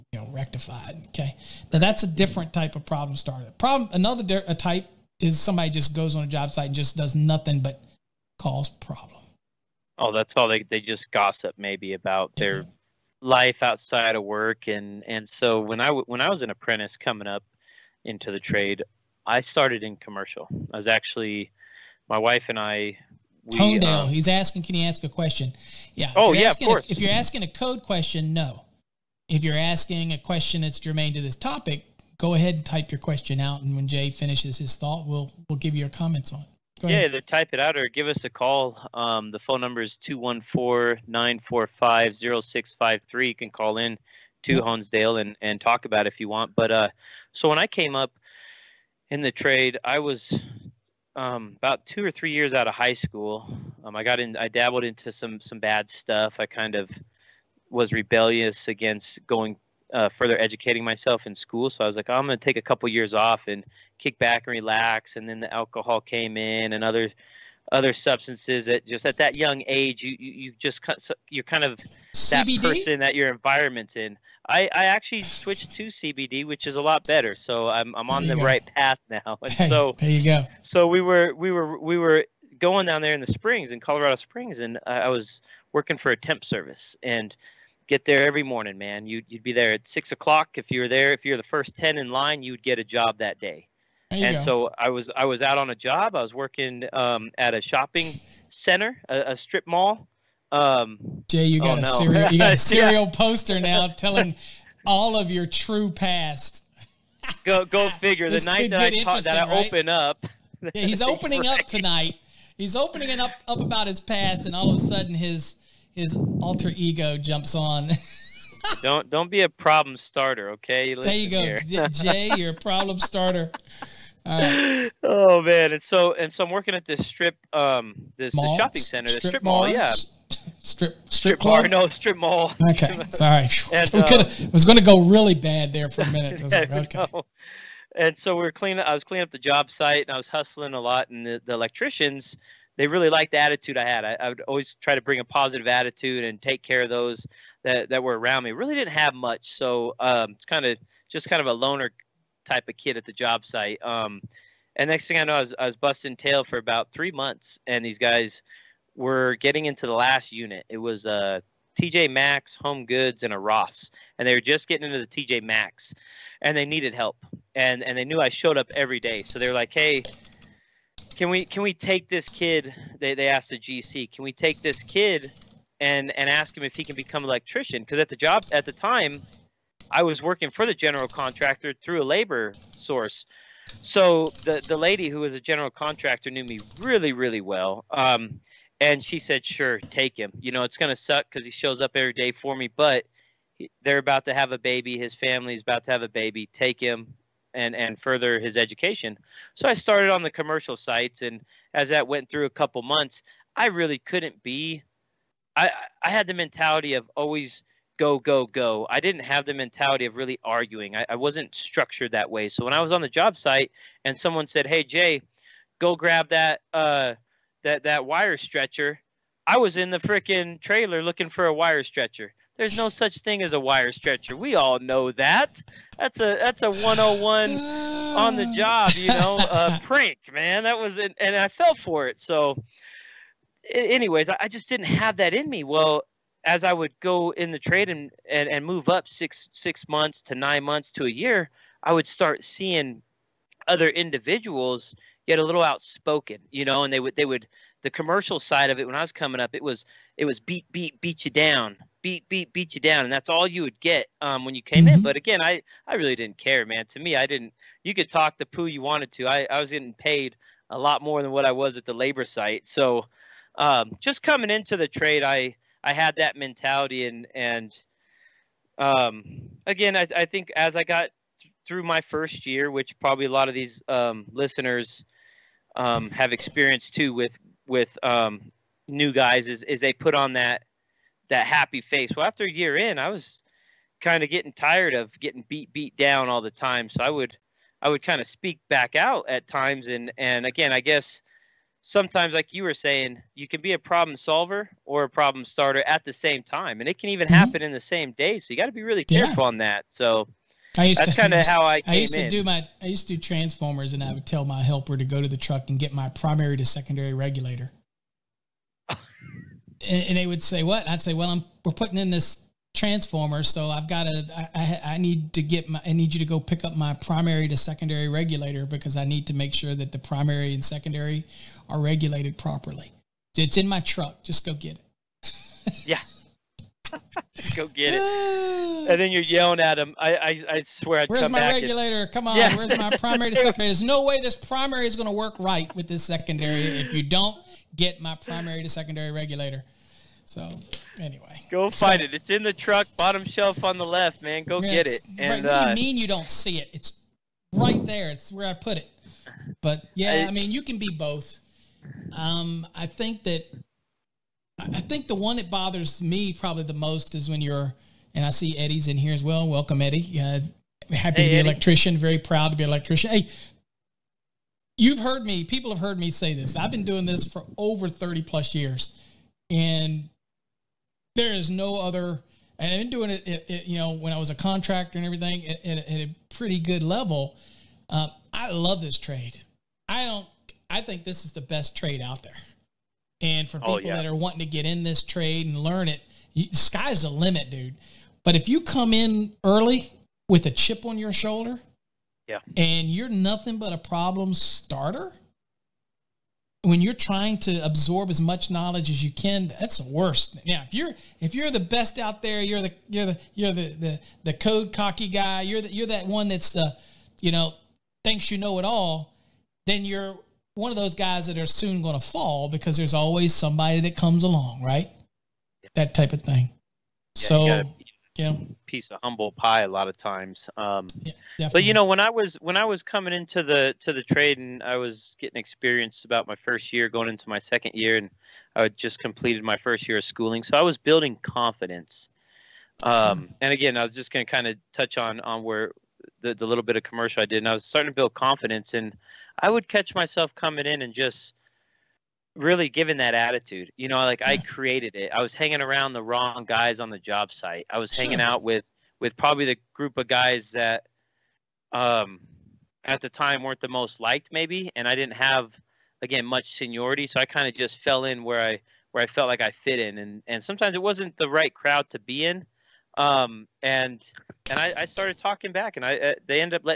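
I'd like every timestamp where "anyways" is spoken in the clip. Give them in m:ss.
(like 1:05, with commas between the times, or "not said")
3:53, 5:40.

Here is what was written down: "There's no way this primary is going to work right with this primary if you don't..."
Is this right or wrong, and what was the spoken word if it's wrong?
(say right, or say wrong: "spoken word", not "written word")
wrong: "secondary", not "primary".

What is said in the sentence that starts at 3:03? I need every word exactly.
So the the lady who was a general contractor knew me really really well.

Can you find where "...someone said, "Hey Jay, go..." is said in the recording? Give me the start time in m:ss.
3:34.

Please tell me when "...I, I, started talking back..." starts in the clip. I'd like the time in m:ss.
7:44.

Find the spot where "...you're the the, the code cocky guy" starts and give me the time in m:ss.
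6:43.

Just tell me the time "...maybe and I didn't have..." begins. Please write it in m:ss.
7:34.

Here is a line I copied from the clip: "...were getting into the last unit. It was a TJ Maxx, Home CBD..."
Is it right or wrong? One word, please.
wrong.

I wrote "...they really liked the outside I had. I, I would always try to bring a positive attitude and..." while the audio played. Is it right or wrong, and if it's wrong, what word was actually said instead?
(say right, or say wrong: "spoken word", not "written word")
wrong: "attitude", not "outside".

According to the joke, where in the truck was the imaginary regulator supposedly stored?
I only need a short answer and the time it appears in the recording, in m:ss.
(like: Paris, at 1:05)
Bottom shelf on the left, at 5:42.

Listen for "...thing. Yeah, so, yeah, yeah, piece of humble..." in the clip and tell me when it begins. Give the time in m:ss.
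6:56.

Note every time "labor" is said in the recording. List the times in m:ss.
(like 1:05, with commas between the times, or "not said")
3:02, 4:21.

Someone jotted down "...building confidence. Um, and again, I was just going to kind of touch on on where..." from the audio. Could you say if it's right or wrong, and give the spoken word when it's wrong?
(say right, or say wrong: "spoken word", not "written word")
right.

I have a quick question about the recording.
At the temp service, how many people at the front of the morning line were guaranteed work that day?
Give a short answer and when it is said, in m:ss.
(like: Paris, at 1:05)
10, at 1:31.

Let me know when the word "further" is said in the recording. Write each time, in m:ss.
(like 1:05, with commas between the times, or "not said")
1:00, 3:18.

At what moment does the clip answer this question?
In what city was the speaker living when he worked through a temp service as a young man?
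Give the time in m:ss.
1:23.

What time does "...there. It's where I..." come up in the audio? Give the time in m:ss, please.
5:47.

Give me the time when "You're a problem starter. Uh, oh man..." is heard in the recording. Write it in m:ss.
2:02.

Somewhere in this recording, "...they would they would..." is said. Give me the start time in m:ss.
4:06.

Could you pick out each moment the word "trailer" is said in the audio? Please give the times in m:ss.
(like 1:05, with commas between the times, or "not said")
3:40.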